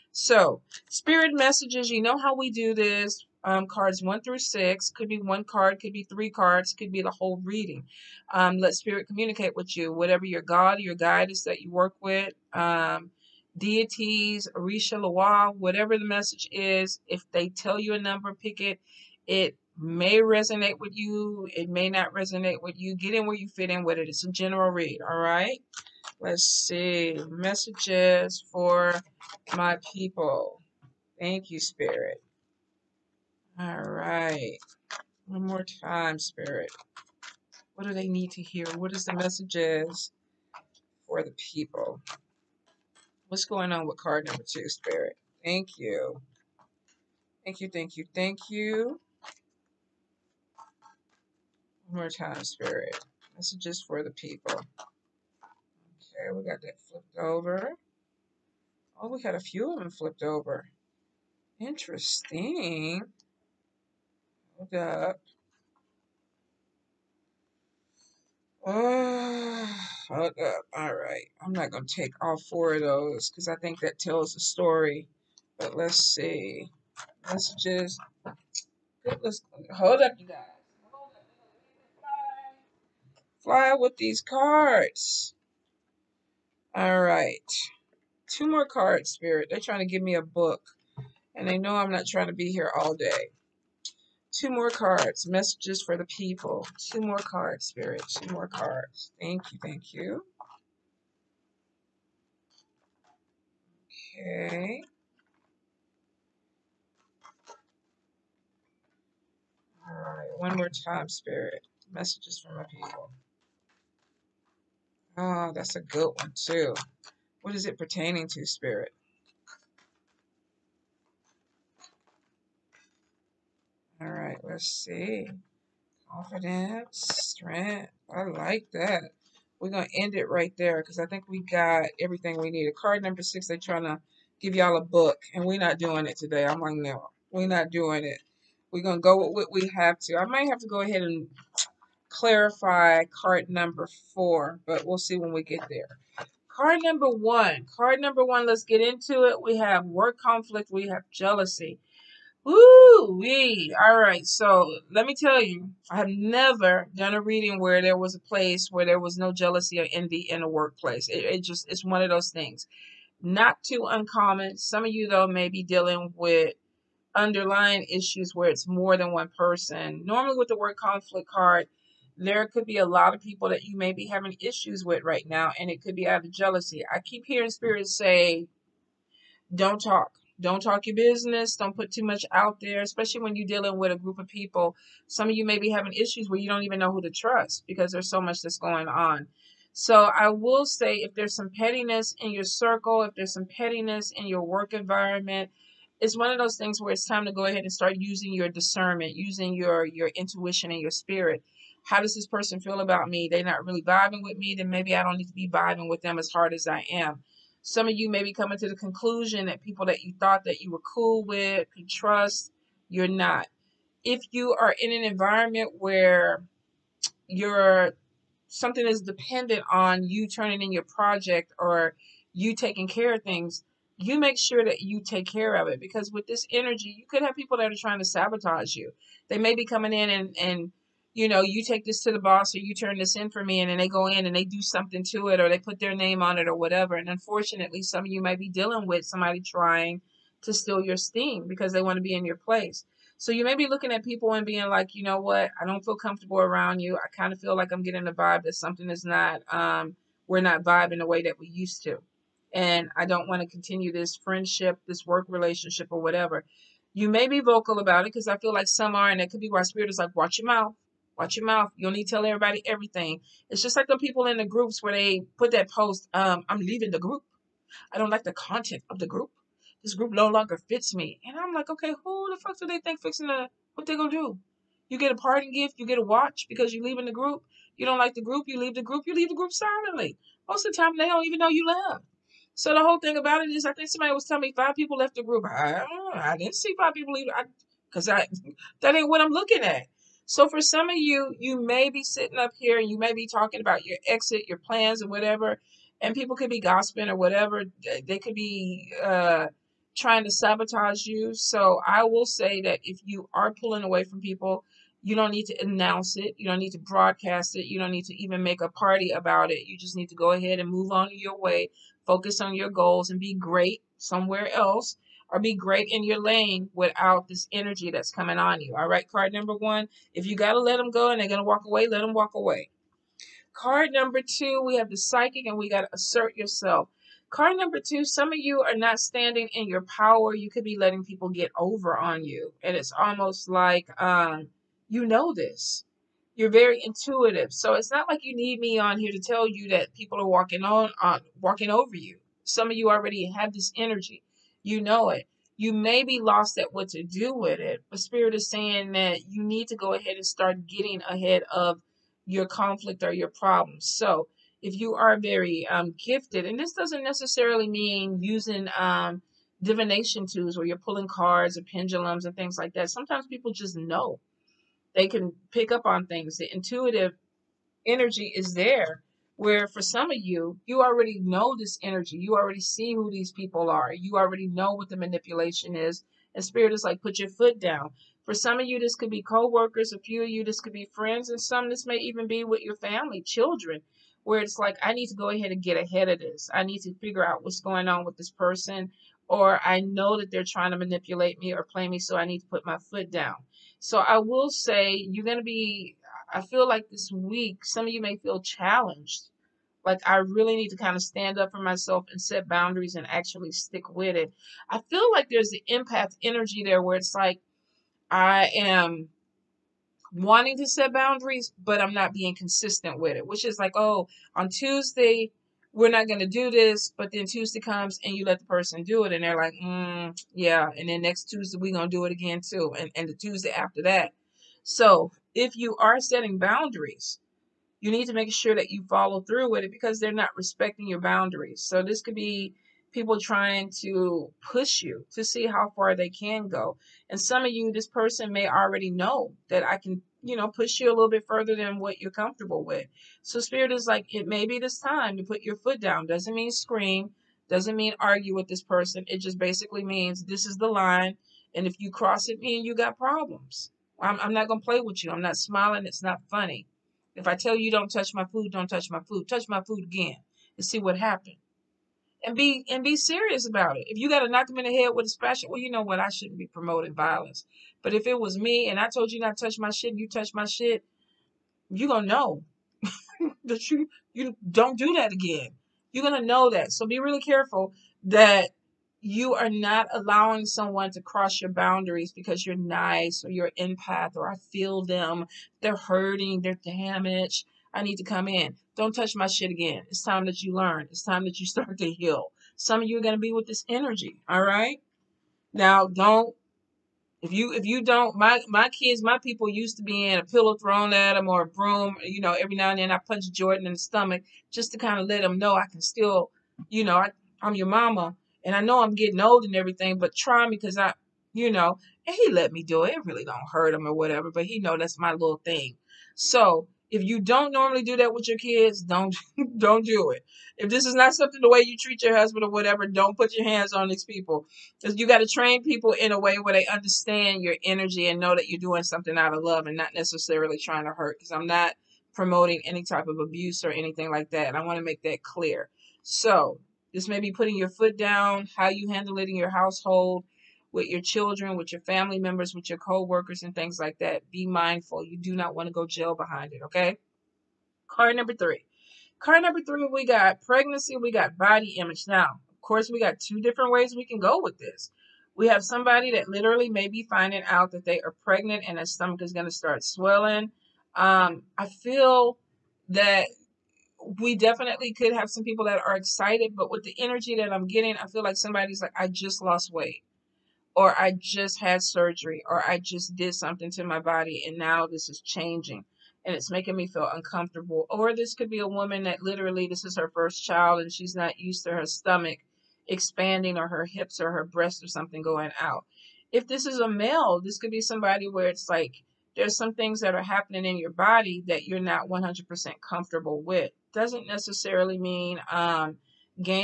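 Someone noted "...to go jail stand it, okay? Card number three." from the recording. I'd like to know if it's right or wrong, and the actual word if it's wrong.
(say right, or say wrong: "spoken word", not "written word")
wrong: "behind", not "stand".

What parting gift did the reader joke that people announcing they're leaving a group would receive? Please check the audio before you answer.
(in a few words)
A watch.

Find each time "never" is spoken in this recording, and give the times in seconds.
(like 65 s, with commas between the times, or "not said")
156 s.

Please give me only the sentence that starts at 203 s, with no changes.
They're not really vibing with me, then maybe I don't need to be vibing with them as hard as I am.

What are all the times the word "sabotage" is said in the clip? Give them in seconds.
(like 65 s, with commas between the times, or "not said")
228 s, 300 s.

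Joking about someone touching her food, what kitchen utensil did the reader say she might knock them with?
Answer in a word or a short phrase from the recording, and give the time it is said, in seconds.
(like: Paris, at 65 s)
A spatula, at 465 s.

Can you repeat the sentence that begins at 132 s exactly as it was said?
Card number six, they're trying to give y'all a book, and we're not doing it today.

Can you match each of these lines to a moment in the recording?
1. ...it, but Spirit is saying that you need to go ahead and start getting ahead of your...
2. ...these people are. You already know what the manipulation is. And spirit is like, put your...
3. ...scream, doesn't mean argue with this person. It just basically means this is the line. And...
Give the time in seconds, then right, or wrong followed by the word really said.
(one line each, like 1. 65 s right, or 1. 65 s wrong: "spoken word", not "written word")
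1. 347 s right
2. 373 s right
3. 446 s right.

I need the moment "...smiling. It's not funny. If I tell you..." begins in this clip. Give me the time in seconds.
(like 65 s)
455 s.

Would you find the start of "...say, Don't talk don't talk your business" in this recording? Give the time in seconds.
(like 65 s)
177 s.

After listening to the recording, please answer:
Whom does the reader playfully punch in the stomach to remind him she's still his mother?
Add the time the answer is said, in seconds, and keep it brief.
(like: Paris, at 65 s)
Jordan, at 503 s.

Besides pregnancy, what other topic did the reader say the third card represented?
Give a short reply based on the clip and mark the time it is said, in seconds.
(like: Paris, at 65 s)
Body image, at 551 s.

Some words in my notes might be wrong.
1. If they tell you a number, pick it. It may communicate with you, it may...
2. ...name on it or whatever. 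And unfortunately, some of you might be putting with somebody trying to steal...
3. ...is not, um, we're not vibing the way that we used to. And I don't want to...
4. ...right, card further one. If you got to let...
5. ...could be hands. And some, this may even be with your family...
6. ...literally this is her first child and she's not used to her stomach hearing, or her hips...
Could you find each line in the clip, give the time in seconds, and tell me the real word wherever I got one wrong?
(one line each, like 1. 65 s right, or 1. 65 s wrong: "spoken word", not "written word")
1. 17 s wrong: "resonate", not "communicate"
2. 235 s wrong: "dealing", not "putting"
3. 248 s right
4. 318 s wrong: "number", not "further"
5. 380 s wrong: "friends", not "hands"
6. 579 s wrong: "expanding", not "hearing".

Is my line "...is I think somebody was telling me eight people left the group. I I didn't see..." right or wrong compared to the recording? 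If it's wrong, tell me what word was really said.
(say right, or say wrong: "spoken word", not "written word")
wrong: "five", not "eight".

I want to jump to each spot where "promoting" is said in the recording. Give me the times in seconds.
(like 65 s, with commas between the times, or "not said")
466 s, 532 s.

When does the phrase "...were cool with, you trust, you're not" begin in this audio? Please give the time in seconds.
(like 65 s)
210 s.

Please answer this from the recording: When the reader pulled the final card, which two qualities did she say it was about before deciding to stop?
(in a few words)
Confidence, strength.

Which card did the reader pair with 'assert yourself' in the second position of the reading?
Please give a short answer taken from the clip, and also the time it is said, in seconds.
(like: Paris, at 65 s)
The psychic, at 324 s.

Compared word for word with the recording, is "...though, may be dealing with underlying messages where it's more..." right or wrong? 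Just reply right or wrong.
wrong.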